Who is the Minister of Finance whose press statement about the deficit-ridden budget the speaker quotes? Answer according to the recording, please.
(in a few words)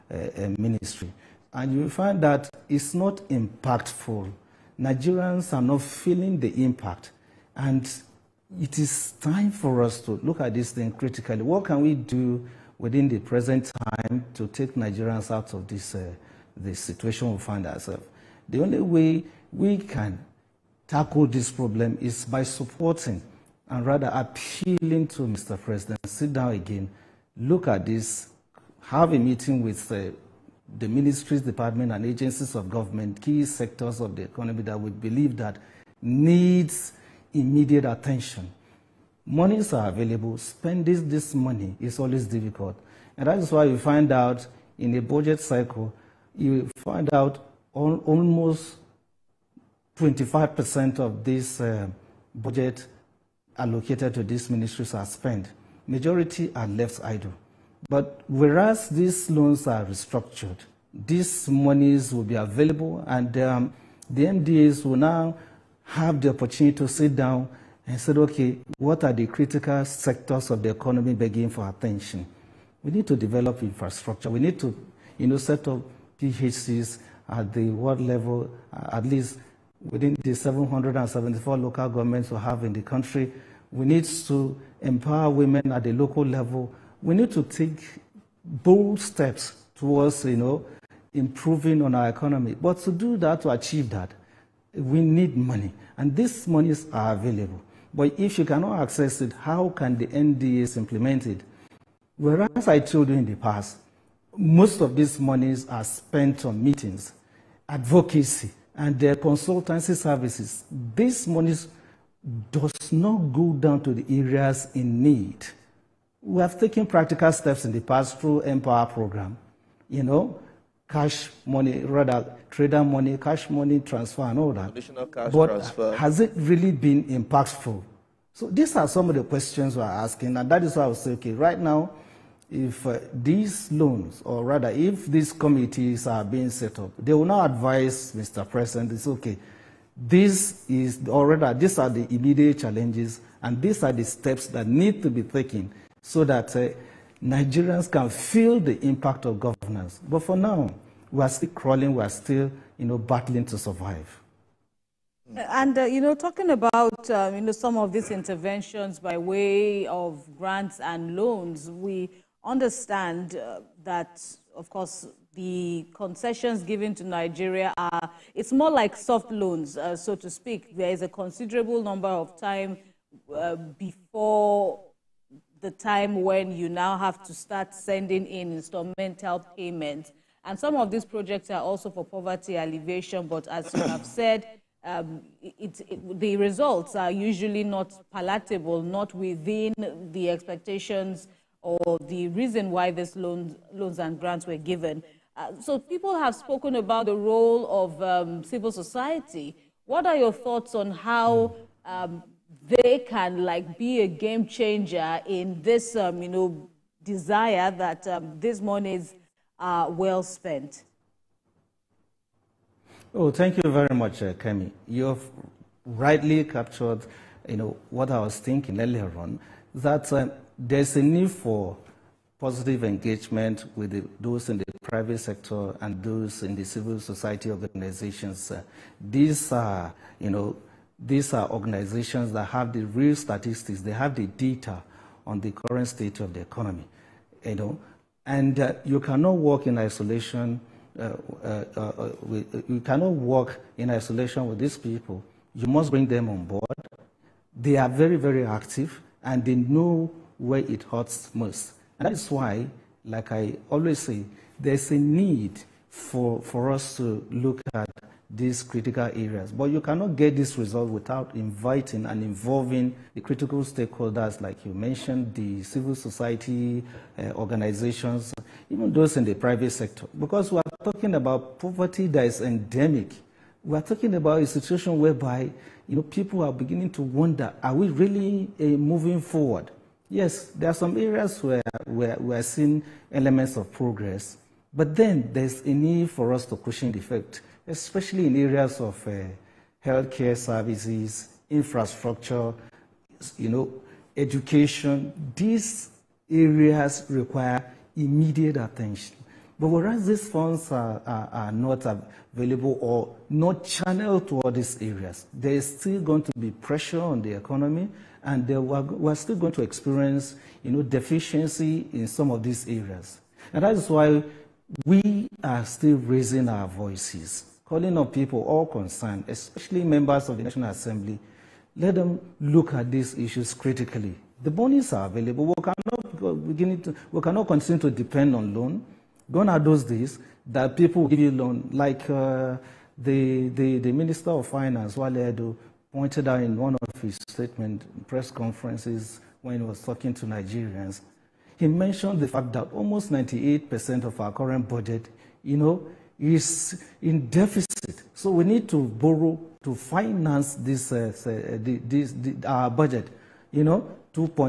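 Wale Edun.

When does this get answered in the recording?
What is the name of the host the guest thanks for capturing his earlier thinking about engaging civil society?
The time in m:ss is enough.
3:34.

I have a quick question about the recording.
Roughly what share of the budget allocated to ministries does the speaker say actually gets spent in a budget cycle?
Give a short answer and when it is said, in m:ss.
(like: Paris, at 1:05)
25%, at 0:49.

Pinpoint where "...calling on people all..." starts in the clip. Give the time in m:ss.
5:17.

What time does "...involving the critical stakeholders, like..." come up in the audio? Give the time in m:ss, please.
4:22.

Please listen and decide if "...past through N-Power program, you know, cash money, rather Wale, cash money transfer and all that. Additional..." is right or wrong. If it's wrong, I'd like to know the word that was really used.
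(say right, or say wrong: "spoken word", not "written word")
wrong: "TraderMoni", not "Wale".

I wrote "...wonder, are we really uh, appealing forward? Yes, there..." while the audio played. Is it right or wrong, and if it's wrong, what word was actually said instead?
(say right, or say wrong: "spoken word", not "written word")
wrong: "moving", not "appealing".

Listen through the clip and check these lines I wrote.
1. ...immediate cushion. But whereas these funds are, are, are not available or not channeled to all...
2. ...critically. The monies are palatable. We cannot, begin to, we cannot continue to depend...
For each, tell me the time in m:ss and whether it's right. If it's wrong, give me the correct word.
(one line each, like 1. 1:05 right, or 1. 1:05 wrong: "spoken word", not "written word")
1. 4:57 wrong: "attention", not "cushion"
2. 5:23 wrong: "available", not "palatable".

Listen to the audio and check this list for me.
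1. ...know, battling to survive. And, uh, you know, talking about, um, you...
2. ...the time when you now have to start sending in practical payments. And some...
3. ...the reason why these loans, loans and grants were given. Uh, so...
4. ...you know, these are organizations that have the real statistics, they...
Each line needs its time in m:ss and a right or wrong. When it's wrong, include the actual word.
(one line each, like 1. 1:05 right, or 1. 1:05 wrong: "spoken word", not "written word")
1. 2:32 right
2. 2:55 wrong: "instrumental", not "practical"
3. 3:12 right
4. 3:50 right.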